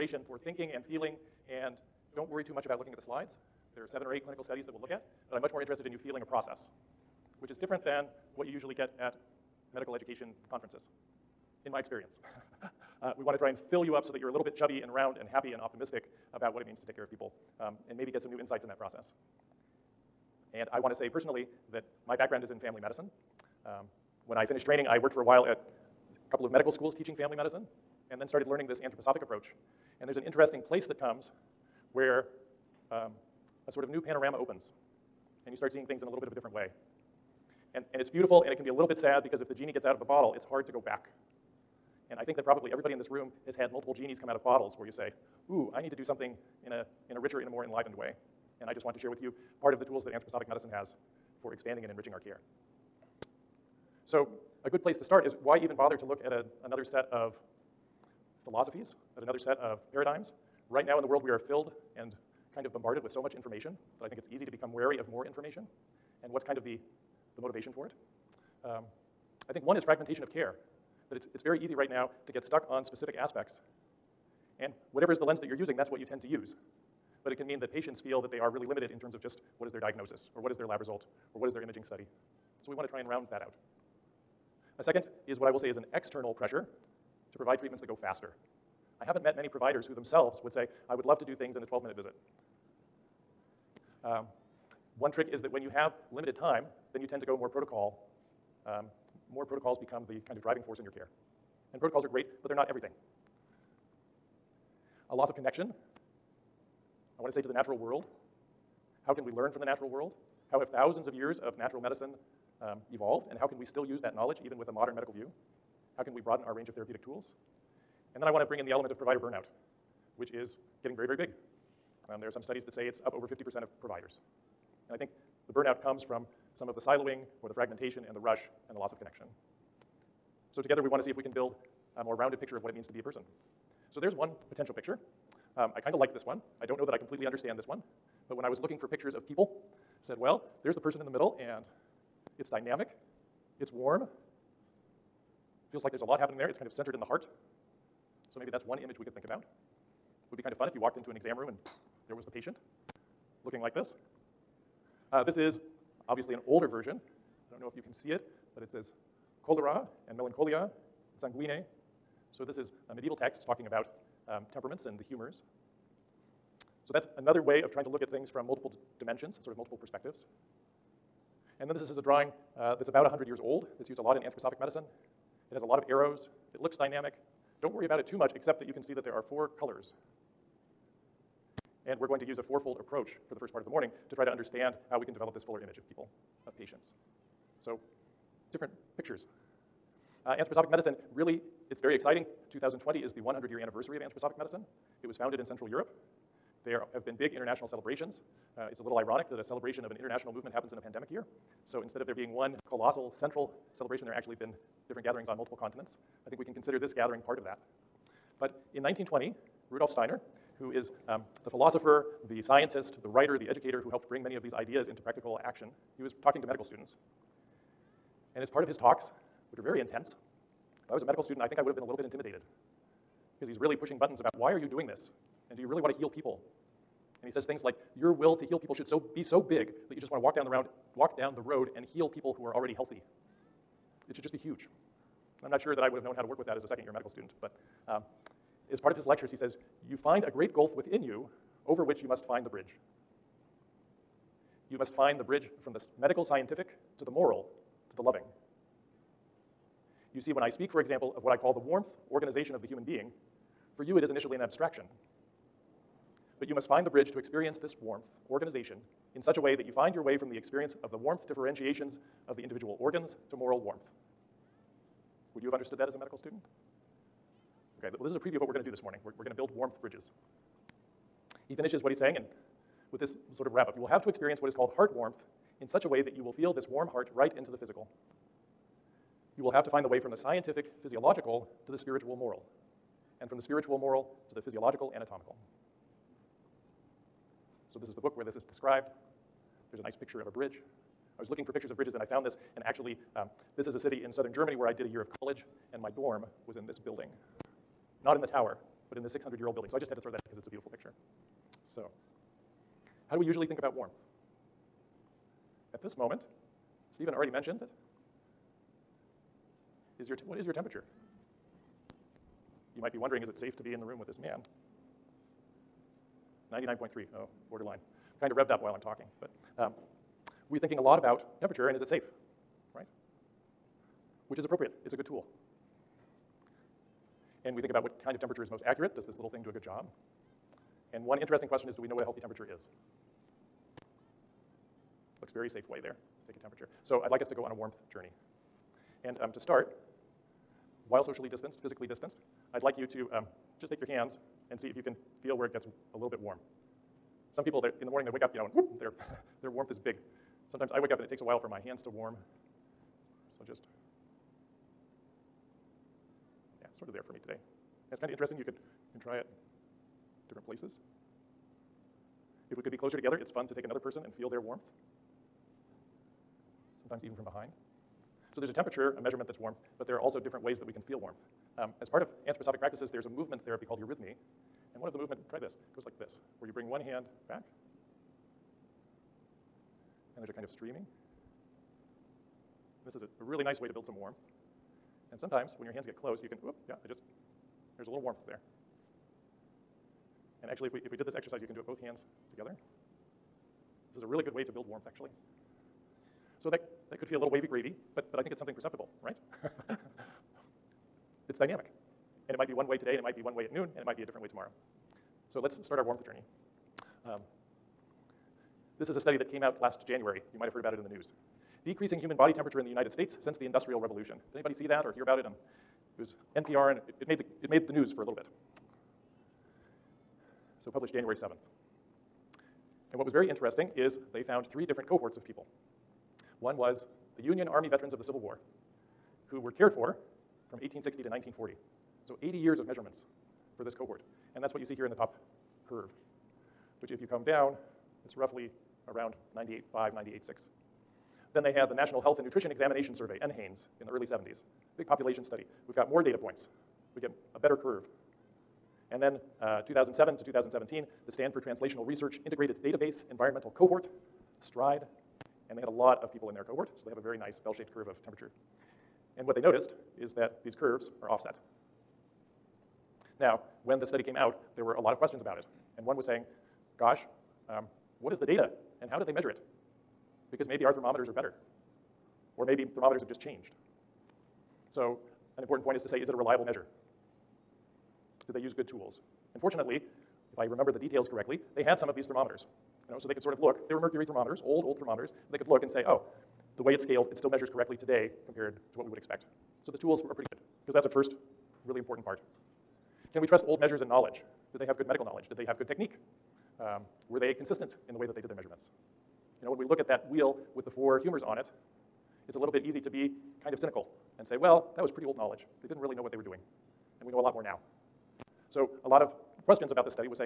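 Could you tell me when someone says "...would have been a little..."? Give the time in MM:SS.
03:41.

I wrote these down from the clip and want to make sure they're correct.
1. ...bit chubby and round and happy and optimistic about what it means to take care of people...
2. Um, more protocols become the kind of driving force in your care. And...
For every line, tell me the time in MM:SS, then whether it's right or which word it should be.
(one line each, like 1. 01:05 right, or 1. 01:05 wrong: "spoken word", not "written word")
1. 00:14 right
2. 01:38 right.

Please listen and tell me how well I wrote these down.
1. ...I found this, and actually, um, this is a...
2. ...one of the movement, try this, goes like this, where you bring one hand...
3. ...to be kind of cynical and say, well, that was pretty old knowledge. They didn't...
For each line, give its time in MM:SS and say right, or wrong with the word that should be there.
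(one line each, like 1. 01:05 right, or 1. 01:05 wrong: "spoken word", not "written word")
1. 04:52 right
2. 06:14 right
3. 08:22 right.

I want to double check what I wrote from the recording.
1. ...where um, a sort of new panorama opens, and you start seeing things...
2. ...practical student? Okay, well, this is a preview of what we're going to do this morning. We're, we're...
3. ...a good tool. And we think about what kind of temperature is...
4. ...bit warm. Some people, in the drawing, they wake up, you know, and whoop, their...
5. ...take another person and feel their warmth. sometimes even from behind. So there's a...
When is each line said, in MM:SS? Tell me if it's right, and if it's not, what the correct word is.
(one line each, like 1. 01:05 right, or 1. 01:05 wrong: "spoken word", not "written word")
1. 00:31 right
2. 04:25 wrong: "medical", not "practical"
3. 05:24 right
4. 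05:46 wrong: "morning", not "drawing"
5. 06:03 right.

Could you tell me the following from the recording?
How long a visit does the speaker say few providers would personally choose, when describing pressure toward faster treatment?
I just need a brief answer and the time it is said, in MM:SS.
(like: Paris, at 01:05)
12 minutes, at 01:31.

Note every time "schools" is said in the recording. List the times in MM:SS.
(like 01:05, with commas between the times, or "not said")
00:26.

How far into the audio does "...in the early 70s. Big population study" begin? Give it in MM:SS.
07:23.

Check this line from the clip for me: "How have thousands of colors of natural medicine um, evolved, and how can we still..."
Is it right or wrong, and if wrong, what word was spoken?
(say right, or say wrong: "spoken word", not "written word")
wrong: "years", not "colors".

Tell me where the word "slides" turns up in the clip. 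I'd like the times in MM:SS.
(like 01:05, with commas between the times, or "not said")
00:03.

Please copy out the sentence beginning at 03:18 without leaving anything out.
Uh, it's a little ironic that a celebration of an international movement happens in a pandemic year.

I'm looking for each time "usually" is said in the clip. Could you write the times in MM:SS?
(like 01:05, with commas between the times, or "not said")
00:08, 05:03.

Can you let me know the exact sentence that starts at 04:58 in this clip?
Not in the tower, but in this 600 year old building.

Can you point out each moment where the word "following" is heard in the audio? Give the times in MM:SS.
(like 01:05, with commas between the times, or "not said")
not said.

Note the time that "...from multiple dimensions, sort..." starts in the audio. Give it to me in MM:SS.
02:48.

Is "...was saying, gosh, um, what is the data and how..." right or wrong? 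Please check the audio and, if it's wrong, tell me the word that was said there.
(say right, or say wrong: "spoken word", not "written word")
right.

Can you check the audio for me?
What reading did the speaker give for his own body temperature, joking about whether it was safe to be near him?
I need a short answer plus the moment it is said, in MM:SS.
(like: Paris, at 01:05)
99.3, at 05:16.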